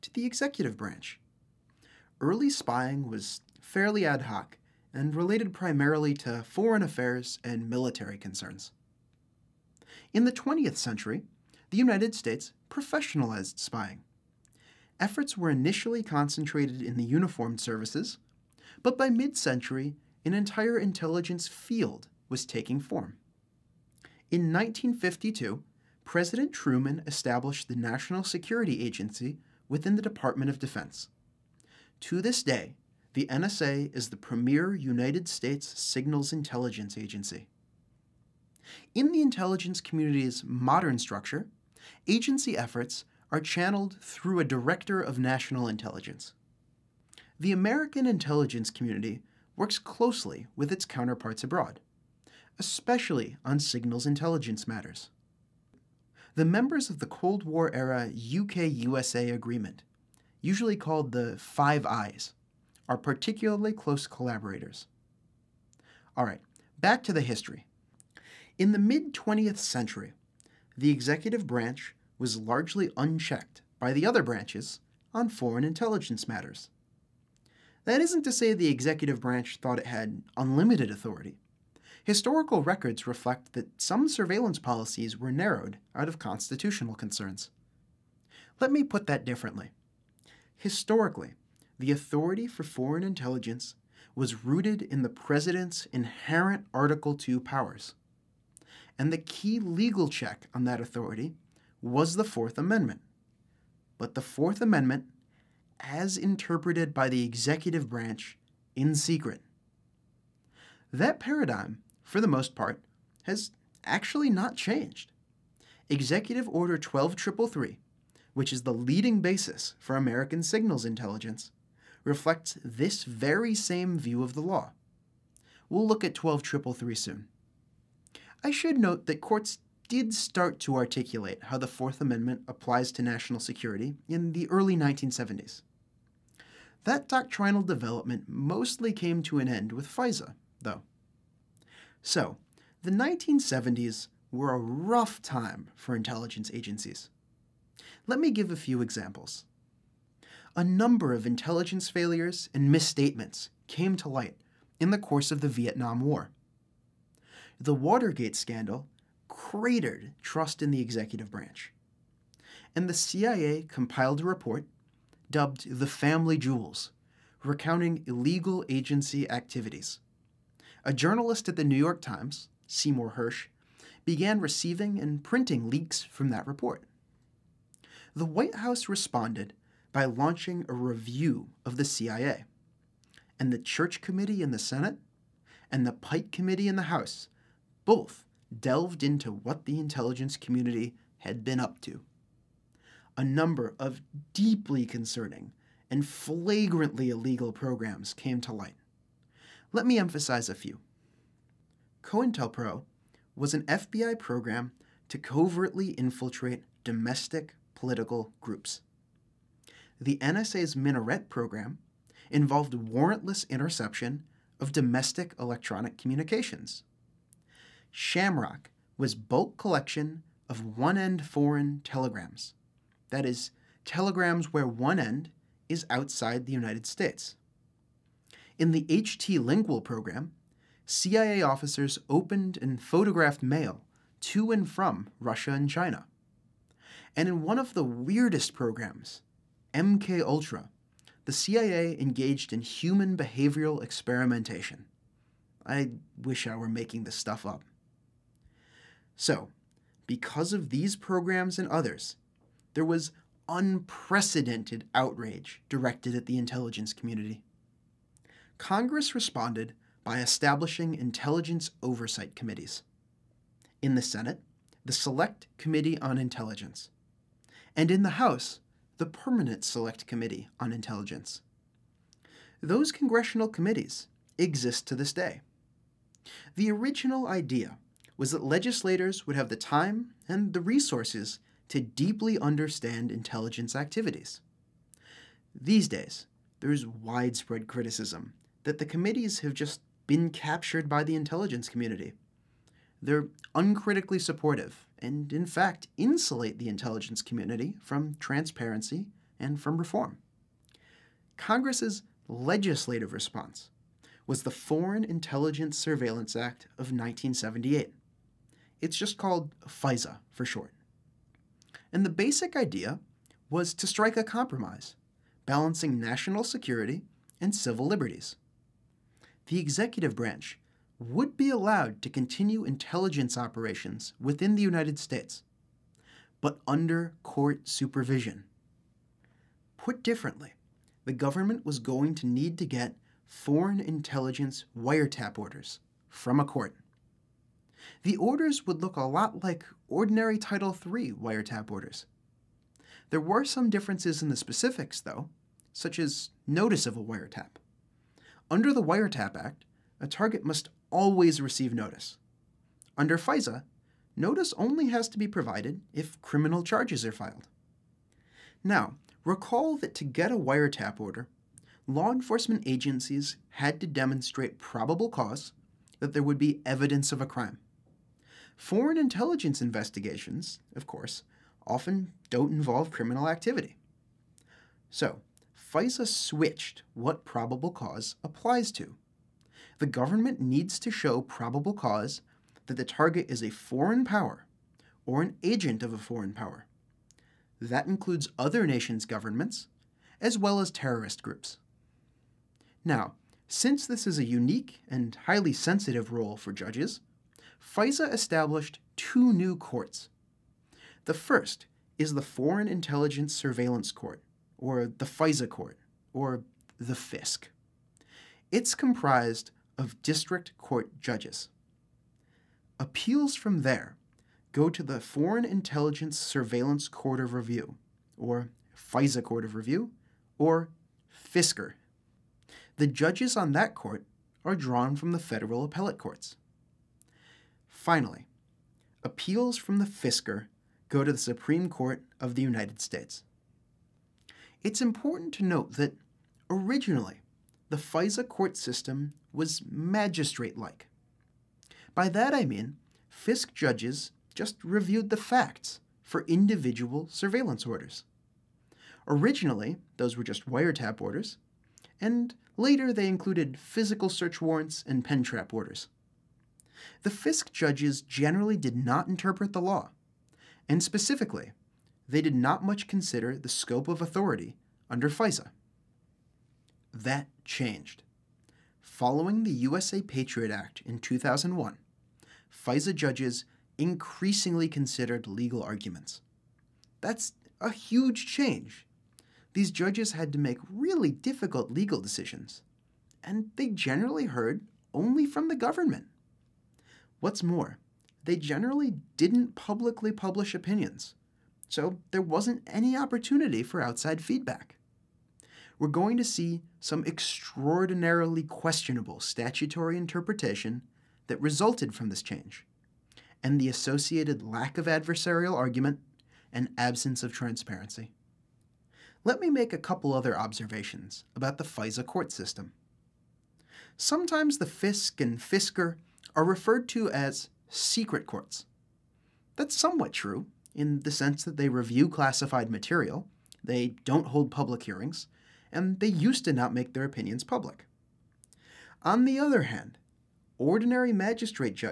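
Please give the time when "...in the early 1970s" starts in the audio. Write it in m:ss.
2:14.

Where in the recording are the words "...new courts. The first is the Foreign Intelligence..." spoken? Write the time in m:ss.
6:39.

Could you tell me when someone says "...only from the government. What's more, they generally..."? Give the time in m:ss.
8:04.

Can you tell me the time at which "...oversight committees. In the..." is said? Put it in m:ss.
4:21.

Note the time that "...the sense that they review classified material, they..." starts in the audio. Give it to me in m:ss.
8:41.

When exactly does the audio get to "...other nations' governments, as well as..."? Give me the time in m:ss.
6:28.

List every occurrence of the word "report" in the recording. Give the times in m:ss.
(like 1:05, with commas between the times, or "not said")
2:44, 2:56.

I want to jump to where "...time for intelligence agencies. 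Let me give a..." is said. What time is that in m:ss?
2:25.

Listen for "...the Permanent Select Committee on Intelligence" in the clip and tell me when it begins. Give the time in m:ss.
4:28.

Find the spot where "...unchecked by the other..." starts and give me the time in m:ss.
1:12.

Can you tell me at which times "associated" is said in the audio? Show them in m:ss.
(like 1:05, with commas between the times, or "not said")
8:23.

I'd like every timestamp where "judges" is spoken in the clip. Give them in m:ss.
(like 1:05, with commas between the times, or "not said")
6:36, 6:51, 7:02, 7:23, 7:37, 7:52, 7:59.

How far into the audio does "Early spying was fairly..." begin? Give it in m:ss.
0:02.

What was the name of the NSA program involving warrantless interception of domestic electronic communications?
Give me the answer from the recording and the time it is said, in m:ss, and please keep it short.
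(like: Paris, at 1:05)
Minaret, at 3:30.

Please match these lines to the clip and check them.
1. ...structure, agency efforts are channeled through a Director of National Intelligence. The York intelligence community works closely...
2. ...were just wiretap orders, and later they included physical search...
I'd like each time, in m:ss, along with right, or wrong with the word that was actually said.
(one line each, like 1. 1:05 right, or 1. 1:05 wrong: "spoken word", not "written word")
1. 0:40 wrong: "American", not "York"
2. 7:30 right.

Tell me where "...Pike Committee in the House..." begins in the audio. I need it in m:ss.
3:05.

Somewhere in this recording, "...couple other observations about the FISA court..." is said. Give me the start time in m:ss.
8:29.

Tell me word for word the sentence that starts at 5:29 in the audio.
Put differently, the government was going to need to get foreign intelligence wiretap orders from a court.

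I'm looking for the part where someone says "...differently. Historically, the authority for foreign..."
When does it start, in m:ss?
1:29.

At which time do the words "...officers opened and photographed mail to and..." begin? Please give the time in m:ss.
3:51.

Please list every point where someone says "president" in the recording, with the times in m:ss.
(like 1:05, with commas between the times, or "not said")
0:26, 1:35.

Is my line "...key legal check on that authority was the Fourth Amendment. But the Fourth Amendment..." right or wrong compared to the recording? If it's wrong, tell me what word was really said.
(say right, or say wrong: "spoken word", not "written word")
right.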